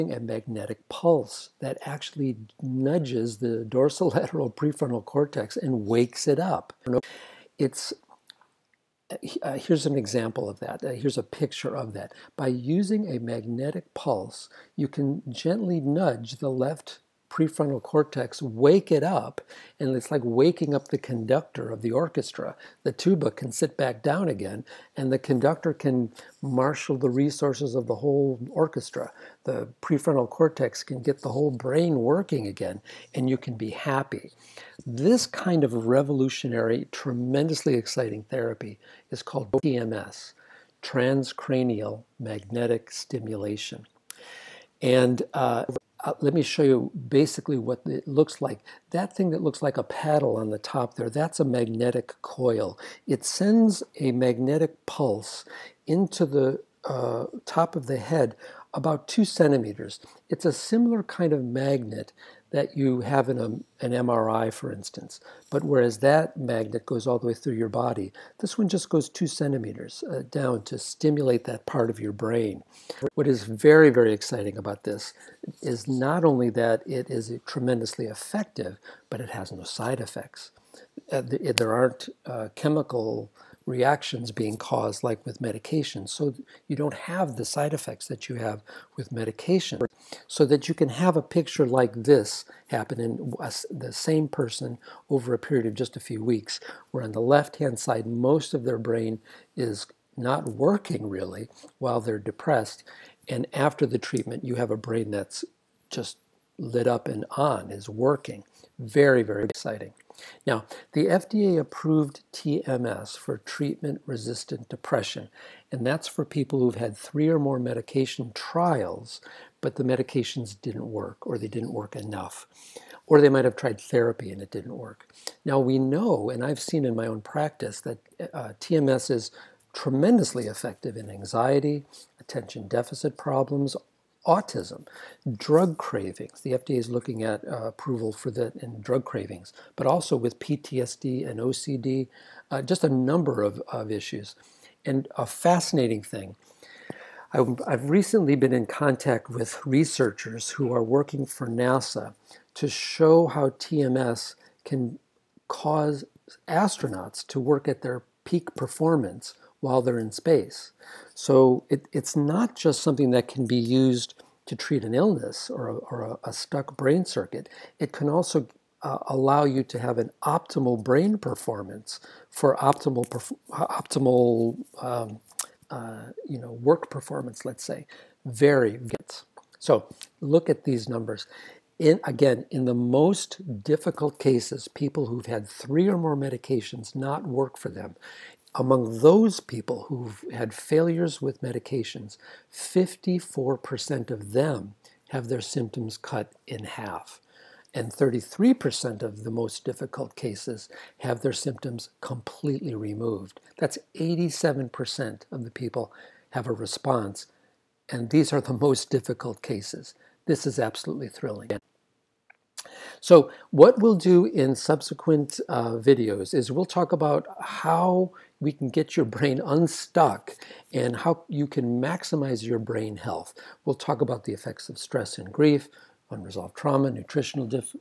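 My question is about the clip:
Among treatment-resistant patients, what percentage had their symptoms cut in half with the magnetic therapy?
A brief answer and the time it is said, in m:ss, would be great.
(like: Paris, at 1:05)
54%, at 3:12.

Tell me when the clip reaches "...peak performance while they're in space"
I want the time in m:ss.
2:38.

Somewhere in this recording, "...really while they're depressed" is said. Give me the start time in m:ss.
1:41.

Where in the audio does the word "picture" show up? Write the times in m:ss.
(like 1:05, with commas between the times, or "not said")
0:11, 1:31.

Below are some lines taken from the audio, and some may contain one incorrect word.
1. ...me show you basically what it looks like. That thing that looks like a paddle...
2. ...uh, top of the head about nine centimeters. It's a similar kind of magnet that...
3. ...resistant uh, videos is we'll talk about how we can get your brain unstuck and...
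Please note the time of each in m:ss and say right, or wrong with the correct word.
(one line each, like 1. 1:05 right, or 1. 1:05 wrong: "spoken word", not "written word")
1. 0:46 right
2. 0:56 wrong: "two", not "nine"
3. 3:34 wrong: "subsequent", not "resistant".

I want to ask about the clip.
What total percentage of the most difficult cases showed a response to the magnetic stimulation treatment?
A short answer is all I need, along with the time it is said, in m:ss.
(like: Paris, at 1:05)
87%, at 3:23.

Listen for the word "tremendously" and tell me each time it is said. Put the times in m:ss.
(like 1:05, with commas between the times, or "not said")
0:36, 1:17, 2:09.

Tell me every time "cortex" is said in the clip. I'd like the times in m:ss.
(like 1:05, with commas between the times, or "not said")
0:05, 0:17, 0:30.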